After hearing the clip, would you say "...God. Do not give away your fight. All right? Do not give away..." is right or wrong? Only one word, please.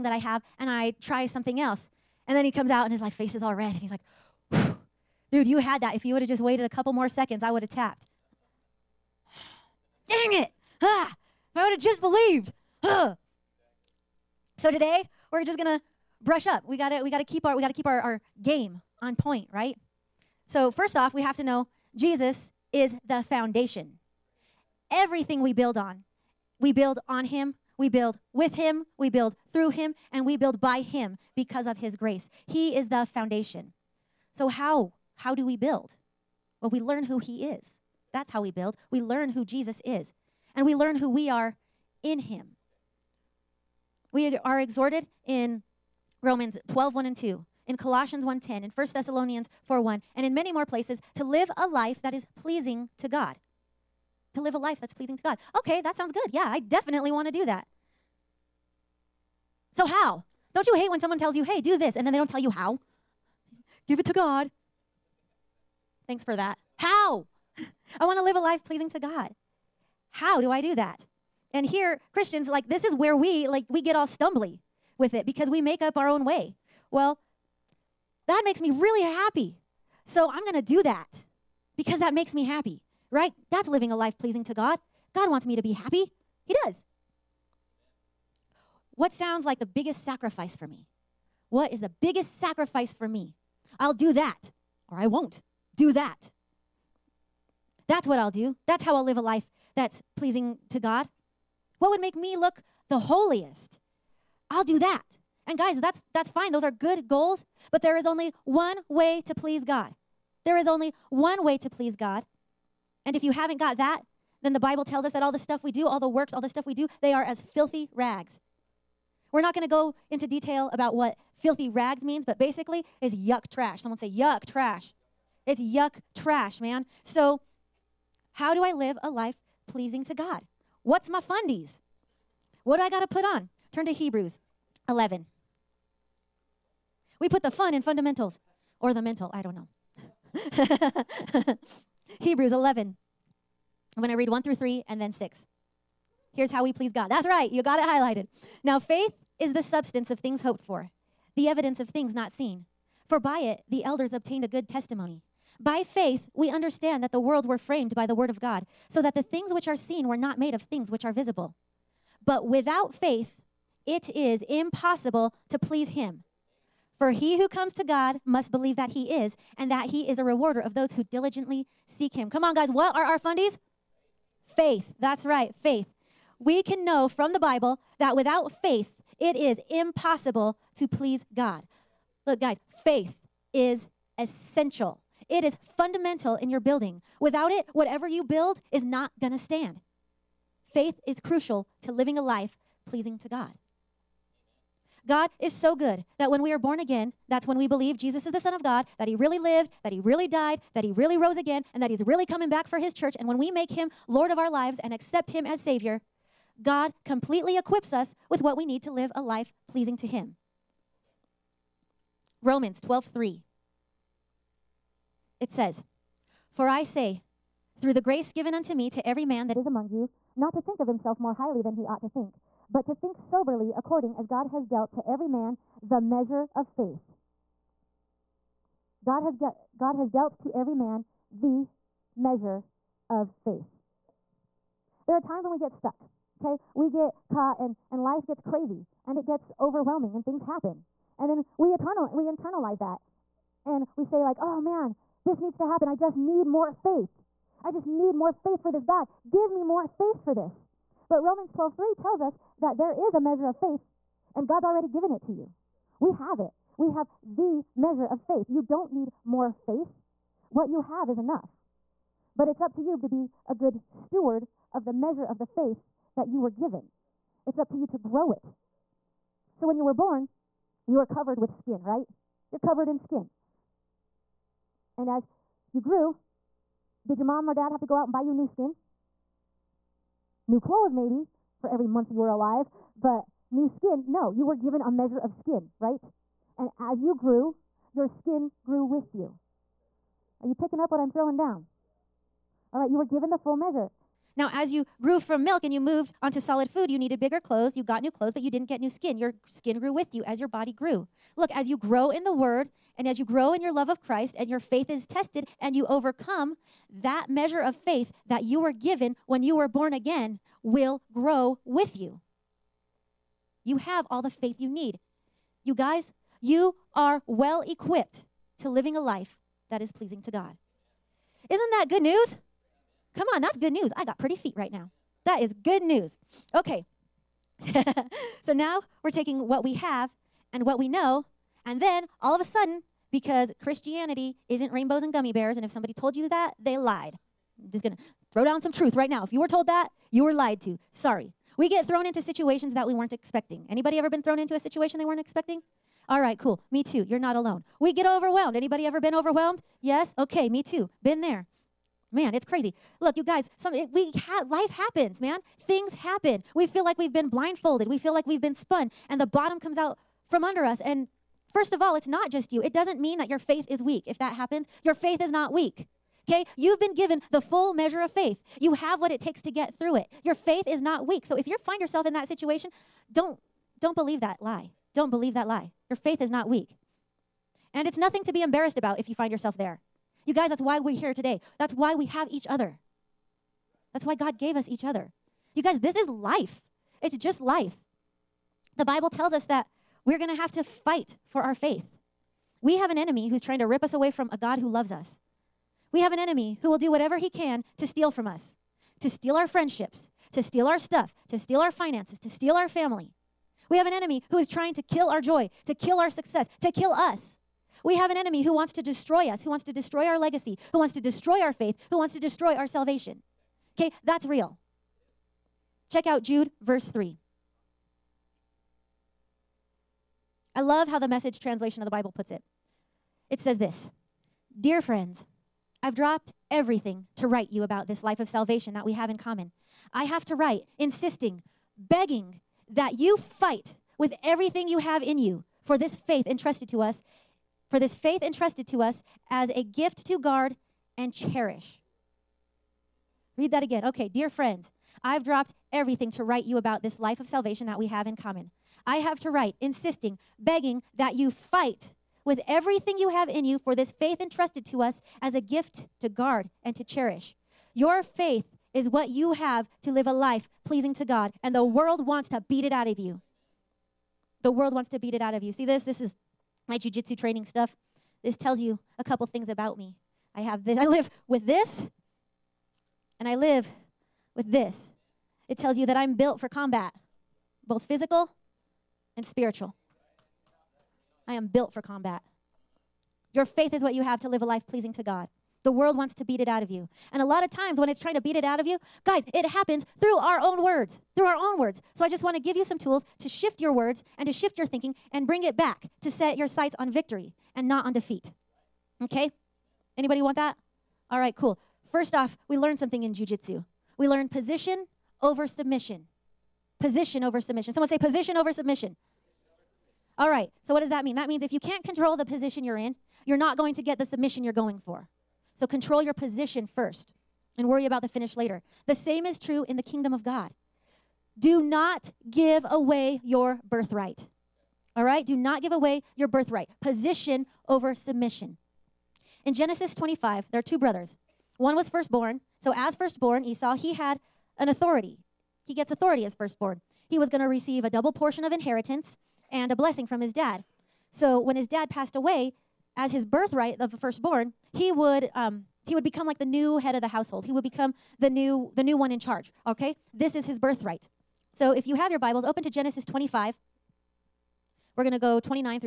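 wrong.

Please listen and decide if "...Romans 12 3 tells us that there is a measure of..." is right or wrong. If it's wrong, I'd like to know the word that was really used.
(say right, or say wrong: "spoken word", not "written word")
right.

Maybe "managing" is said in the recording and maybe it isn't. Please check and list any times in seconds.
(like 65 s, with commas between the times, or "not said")
not said.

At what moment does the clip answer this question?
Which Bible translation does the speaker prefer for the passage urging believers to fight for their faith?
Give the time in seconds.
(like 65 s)
421 s.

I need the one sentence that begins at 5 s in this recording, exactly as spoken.
If you would have just waited a couple more seconds, I would have tapped.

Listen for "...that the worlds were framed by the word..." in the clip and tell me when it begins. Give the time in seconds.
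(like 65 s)
157 s.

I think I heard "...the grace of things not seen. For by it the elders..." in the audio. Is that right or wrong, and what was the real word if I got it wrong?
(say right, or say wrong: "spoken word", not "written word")
wrong: "evidence", not "grace".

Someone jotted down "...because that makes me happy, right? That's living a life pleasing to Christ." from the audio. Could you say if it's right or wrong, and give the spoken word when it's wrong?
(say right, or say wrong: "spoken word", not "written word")
wrong: "God", not "Christ".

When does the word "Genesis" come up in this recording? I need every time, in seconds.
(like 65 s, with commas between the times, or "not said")
529 s, 552 s.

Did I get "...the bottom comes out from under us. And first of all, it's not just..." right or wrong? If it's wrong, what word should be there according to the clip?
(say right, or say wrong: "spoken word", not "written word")
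right.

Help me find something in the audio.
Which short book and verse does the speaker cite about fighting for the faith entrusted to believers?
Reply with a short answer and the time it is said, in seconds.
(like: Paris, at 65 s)
Jude 3, at 416 s.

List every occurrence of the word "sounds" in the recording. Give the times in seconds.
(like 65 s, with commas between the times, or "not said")
55 s, 89 s.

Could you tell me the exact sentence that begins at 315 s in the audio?
You guys, you are well equipped to living a life that is pleasing to God.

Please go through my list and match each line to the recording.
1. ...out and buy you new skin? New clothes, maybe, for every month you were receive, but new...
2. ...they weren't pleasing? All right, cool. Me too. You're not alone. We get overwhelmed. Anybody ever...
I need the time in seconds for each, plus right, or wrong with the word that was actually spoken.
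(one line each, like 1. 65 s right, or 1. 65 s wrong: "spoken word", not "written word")
1. 277 s wrong: "alive", not "receive"
2. 344 s wrong: "expecting", not "pleasing".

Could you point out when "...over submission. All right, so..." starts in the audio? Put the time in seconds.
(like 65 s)
508 s.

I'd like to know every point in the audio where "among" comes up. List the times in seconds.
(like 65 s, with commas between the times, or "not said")
219 s.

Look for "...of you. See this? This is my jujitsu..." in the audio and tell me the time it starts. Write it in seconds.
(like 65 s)
465 s.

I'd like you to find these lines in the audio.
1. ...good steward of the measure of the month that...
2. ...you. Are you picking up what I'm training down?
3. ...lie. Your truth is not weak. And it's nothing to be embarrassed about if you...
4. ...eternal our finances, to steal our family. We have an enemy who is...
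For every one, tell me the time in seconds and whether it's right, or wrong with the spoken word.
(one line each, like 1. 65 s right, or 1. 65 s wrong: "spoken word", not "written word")
1. 263 s wrong: "faith", not "month"
2. 289 s wrong: "throwing", not "training"
3. 375 s wrong: "faith", not "truth"
4. 401 s wrong: "steal", not "eternal".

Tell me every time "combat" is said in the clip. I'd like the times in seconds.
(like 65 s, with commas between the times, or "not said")
476 s, 481 s.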